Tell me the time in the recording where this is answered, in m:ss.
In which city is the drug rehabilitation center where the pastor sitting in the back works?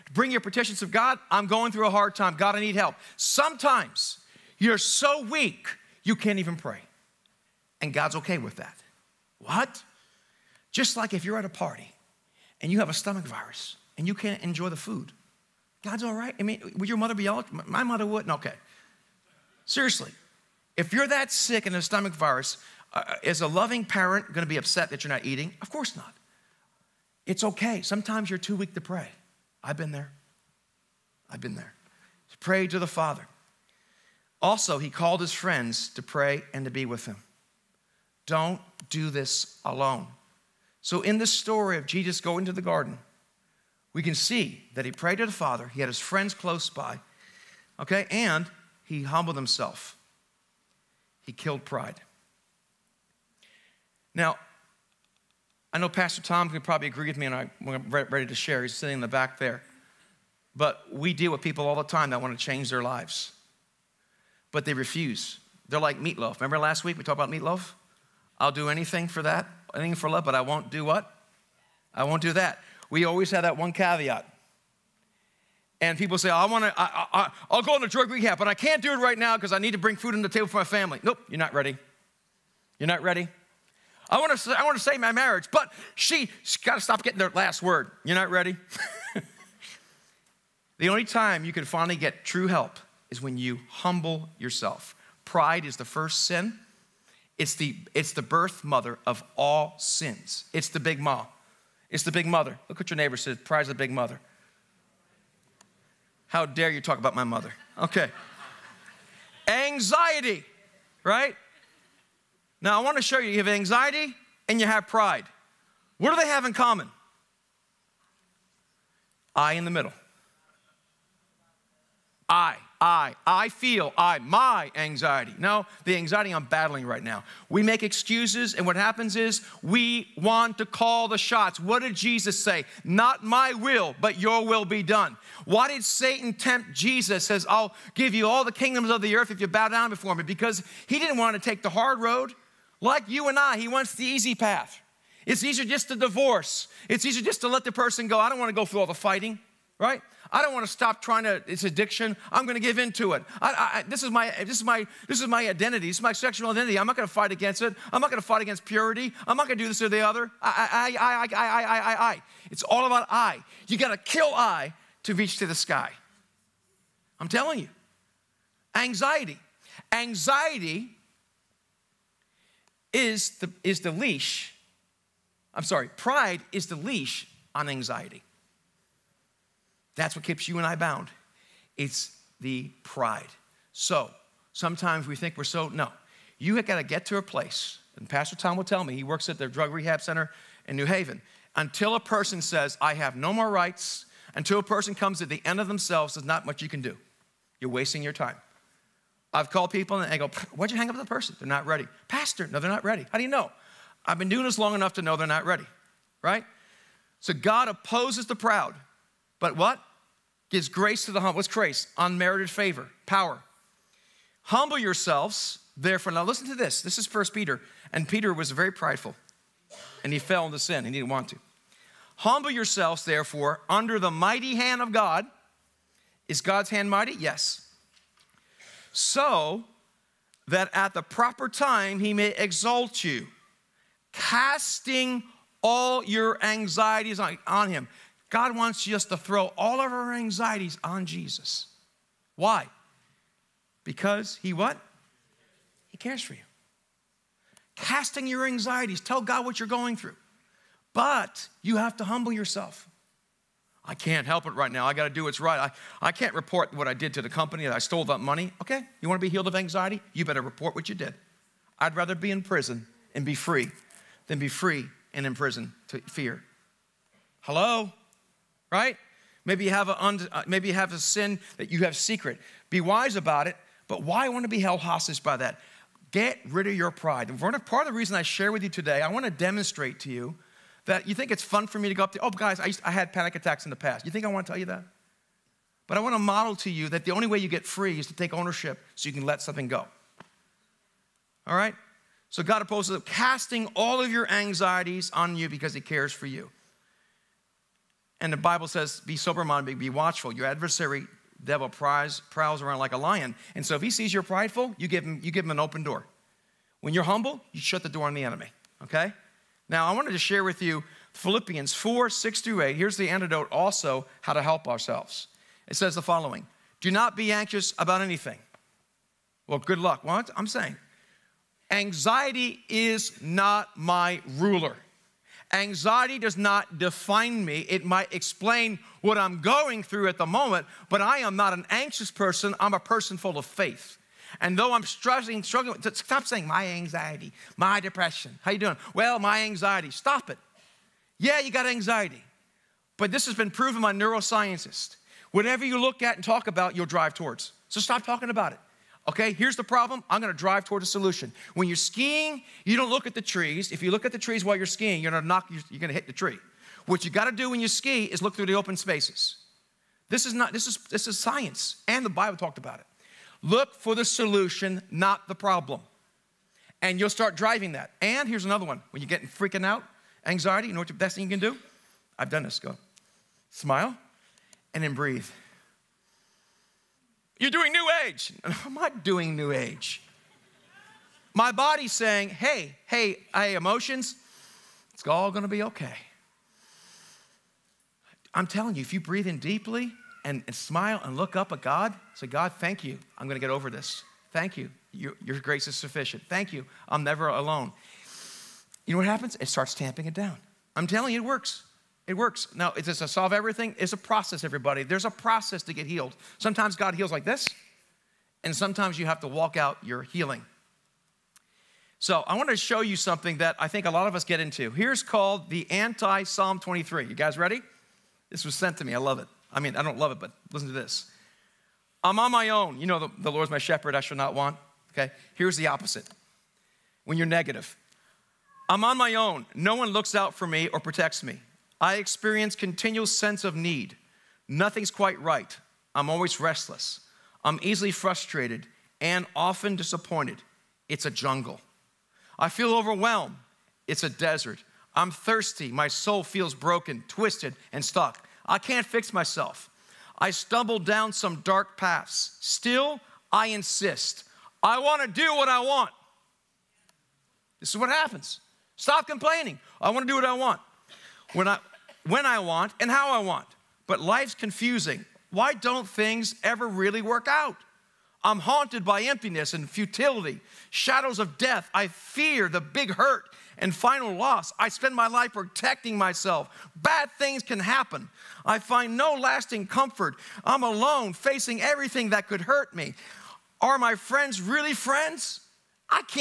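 3:10.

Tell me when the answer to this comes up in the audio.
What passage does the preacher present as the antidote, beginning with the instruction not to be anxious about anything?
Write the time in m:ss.
5:11.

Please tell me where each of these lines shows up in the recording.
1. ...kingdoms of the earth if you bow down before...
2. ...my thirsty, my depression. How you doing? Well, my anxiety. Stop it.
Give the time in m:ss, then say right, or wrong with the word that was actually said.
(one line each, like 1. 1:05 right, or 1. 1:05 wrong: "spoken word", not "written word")
1. 2:18 right
2. 5:36 wrong: "anxiety", not "thirsty".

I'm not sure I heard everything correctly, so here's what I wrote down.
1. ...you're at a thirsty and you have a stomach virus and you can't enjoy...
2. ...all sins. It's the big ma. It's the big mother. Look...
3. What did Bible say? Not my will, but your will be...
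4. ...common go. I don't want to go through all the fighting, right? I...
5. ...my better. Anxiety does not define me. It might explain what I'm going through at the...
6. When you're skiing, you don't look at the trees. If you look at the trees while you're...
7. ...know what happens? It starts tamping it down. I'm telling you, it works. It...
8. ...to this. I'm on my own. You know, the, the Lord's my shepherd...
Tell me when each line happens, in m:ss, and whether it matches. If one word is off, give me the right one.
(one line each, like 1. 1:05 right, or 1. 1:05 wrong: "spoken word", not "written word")
1. 0:11 wrong: "party", not "thirsty"
2. 1:39 right
3. 2:11 wrong: "Jesus", not "Bible"
4. 2:27 wrong: "person", not "common"
5. 5:23 wrong: "ruler", not "better"
6. 5:51 right
7. 6:38 right
8. 7:00 right.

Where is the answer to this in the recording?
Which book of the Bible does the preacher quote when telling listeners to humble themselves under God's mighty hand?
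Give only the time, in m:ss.
3:37.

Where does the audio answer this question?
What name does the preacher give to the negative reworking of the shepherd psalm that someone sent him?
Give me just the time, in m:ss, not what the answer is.
6:55.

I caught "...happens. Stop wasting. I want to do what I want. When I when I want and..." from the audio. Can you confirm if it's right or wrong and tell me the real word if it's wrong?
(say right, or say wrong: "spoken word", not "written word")
wrong: "complaining", not "wasting".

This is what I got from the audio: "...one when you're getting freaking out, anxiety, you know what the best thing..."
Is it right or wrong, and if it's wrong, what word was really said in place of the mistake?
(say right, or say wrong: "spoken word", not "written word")
right.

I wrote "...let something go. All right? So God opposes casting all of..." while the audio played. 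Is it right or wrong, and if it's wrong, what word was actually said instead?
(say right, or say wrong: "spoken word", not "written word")
right.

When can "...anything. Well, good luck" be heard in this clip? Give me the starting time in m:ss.
5:18.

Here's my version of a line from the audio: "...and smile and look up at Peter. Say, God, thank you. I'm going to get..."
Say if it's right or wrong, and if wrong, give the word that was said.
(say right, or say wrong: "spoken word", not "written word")
wrong: "God", not "Peter".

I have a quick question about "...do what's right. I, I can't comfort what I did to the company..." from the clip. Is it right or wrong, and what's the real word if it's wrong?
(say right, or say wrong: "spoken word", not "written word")
wrong: "report", not "comfort".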